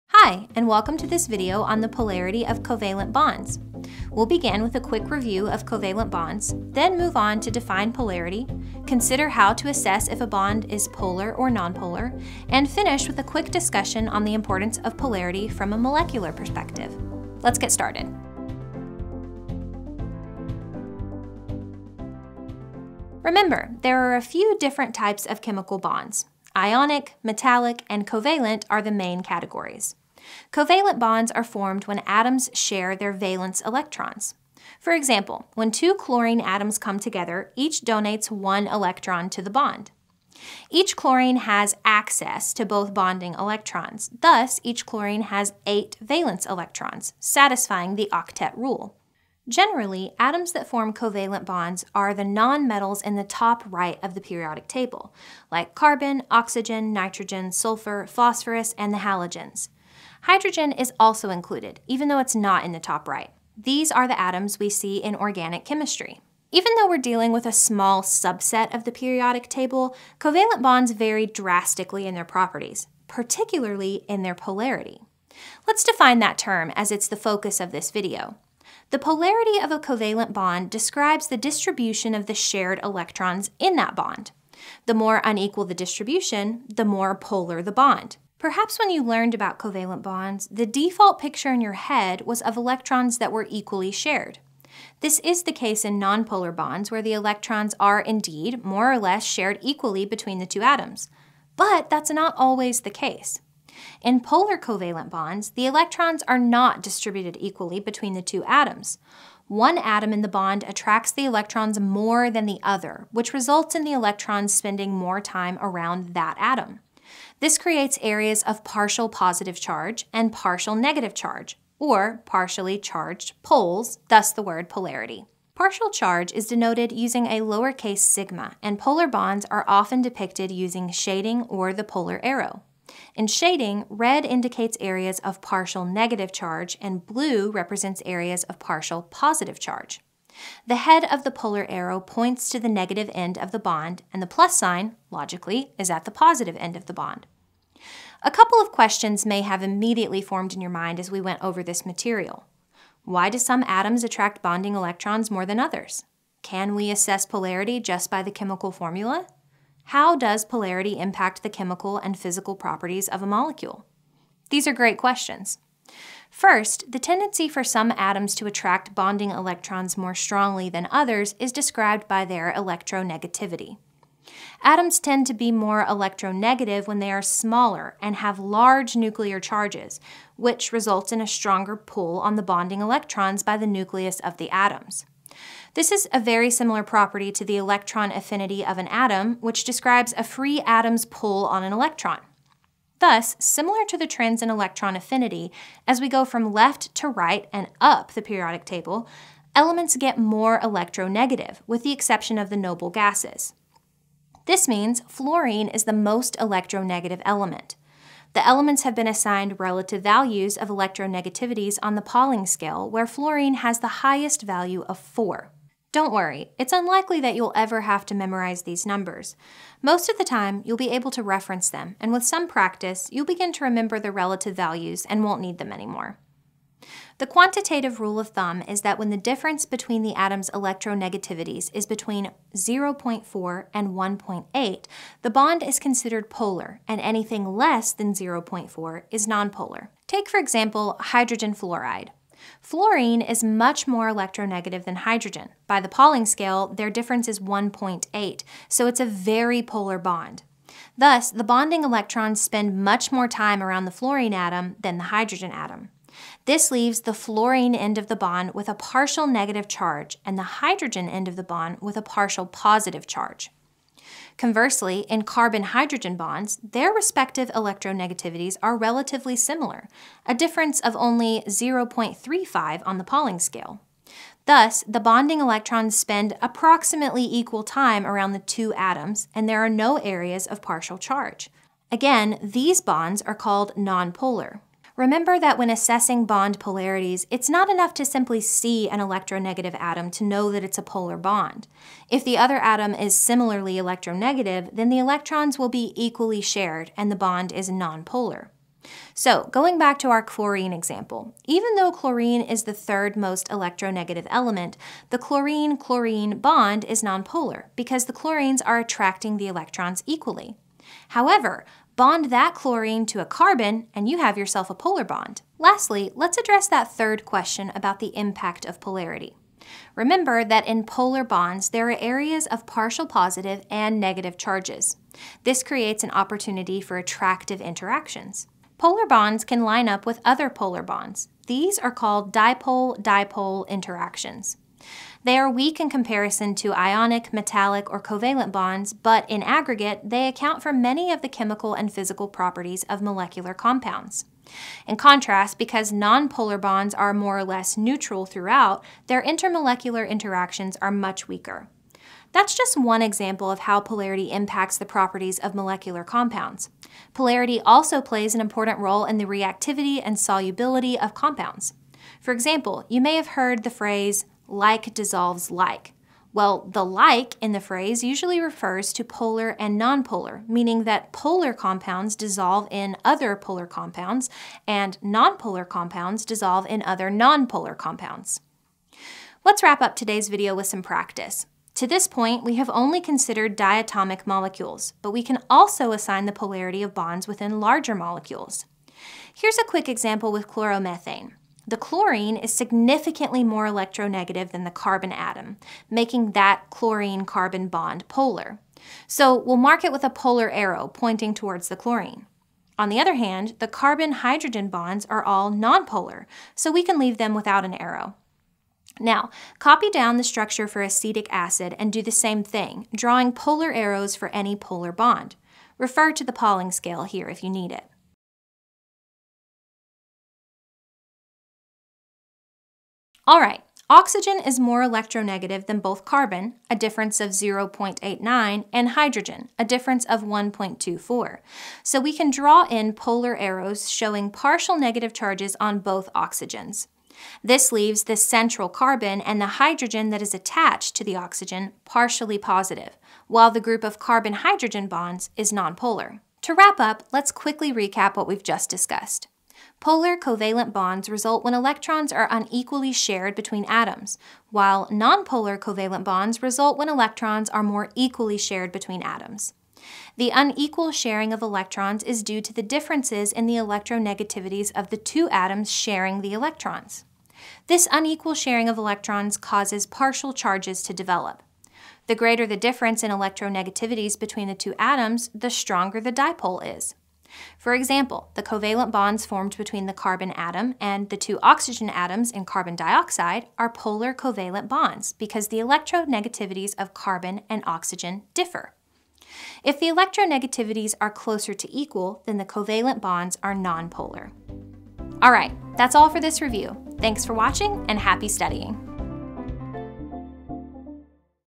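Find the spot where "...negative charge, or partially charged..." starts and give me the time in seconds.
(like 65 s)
120 s.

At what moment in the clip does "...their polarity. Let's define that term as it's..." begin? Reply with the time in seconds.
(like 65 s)
74 s.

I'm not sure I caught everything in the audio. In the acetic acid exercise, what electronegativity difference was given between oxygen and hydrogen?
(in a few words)
1.24.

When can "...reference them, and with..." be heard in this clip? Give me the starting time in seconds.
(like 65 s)
221 s.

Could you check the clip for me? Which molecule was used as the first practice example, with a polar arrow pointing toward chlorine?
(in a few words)
chloromethane.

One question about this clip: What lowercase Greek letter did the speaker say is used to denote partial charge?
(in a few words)
sigma.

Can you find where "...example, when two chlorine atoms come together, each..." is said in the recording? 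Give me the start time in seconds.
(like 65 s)
34 s.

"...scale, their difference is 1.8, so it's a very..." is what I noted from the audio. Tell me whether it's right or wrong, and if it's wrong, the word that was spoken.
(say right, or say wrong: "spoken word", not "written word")
right.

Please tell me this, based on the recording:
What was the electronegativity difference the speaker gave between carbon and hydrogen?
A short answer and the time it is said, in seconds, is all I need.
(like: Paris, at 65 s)
0.35, at 271 s.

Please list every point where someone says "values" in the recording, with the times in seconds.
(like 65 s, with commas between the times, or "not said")
210 s, 214 s, 224 s.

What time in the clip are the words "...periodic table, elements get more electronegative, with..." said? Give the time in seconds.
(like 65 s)
198 s.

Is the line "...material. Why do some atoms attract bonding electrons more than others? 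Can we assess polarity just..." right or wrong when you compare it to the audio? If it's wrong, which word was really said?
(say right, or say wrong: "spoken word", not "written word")
right.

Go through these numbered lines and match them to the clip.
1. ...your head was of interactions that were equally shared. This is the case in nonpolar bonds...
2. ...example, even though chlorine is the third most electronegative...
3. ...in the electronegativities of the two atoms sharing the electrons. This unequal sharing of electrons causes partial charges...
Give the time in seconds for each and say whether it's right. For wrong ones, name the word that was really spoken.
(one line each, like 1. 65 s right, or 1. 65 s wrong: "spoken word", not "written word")
1. 91 s wrong: "electrons", not "interactions"
2. 300 s right
3. 463 s right.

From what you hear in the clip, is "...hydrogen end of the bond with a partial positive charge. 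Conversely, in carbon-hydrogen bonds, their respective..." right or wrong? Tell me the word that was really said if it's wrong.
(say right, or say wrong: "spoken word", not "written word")
right.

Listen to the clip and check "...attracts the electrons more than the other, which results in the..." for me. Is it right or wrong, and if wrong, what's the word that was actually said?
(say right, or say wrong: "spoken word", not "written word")
right.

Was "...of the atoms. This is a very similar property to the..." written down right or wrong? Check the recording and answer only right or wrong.
right.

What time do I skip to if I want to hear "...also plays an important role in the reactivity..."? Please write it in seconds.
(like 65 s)
357 s.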